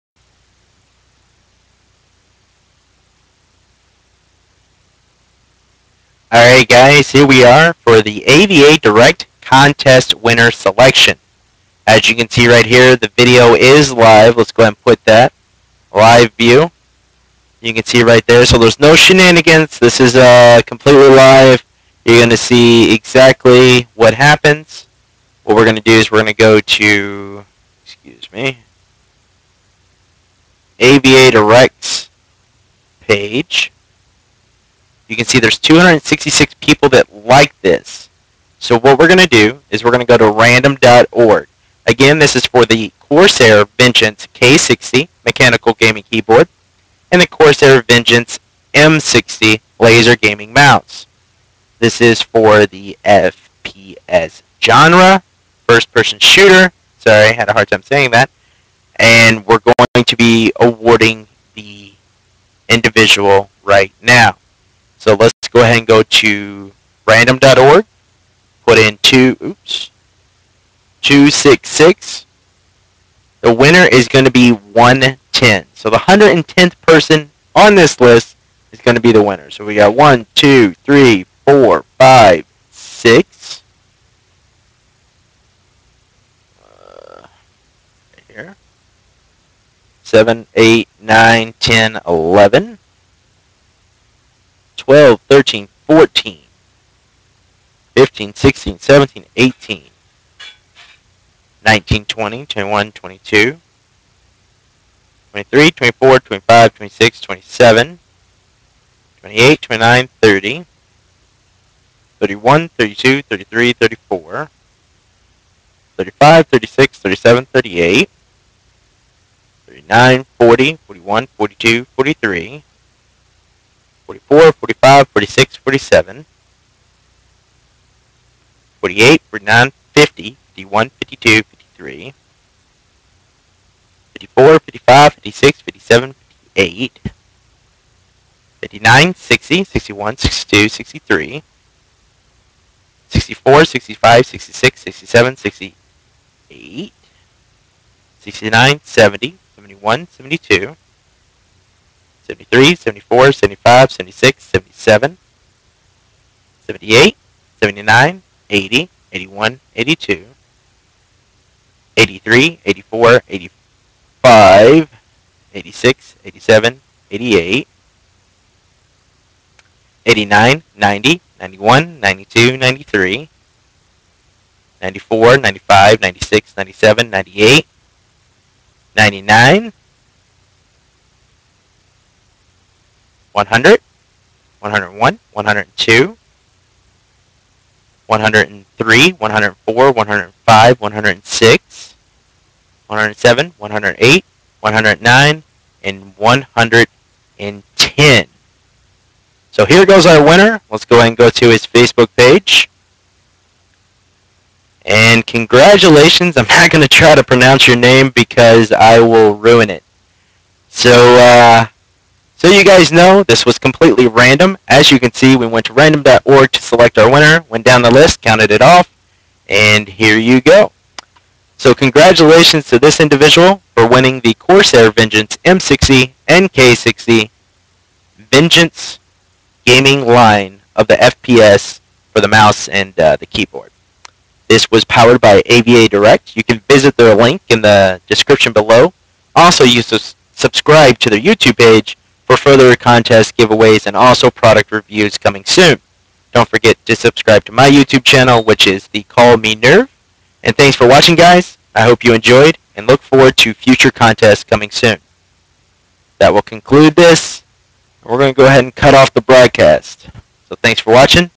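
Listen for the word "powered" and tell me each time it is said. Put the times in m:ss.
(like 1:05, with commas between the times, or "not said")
3:54.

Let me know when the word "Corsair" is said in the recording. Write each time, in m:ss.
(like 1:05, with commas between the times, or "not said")
0:42, 0:47, 3:44.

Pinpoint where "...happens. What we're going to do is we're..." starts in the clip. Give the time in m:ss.
0:24.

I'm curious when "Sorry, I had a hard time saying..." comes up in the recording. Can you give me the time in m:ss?
0:56.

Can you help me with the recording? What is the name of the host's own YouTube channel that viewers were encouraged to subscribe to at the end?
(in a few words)
Call Me Nerve.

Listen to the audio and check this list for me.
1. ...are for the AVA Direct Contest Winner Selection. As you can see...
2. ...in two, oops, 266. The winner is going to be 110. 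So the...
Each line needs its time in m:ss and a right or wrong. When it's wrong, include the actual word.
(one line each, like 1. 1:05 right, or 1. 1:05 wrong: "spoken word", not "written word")
1. 0:07 right
2. 1:08 right.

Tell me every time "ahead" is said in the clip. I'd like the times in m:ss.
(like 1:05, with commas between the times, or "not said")
0:14, 1:05, 4:18.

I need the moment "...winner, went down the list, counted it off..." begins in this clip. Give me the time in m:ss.
3:37.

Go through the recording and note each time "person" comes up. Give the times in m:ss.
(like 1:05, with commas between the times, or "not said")
0:55, 1:16.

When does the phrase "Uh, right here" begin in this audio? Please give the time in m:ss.
1:26.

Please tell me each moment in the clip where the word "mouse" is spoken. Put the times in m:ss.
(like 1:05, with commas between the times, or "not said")
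0:50, 3:52.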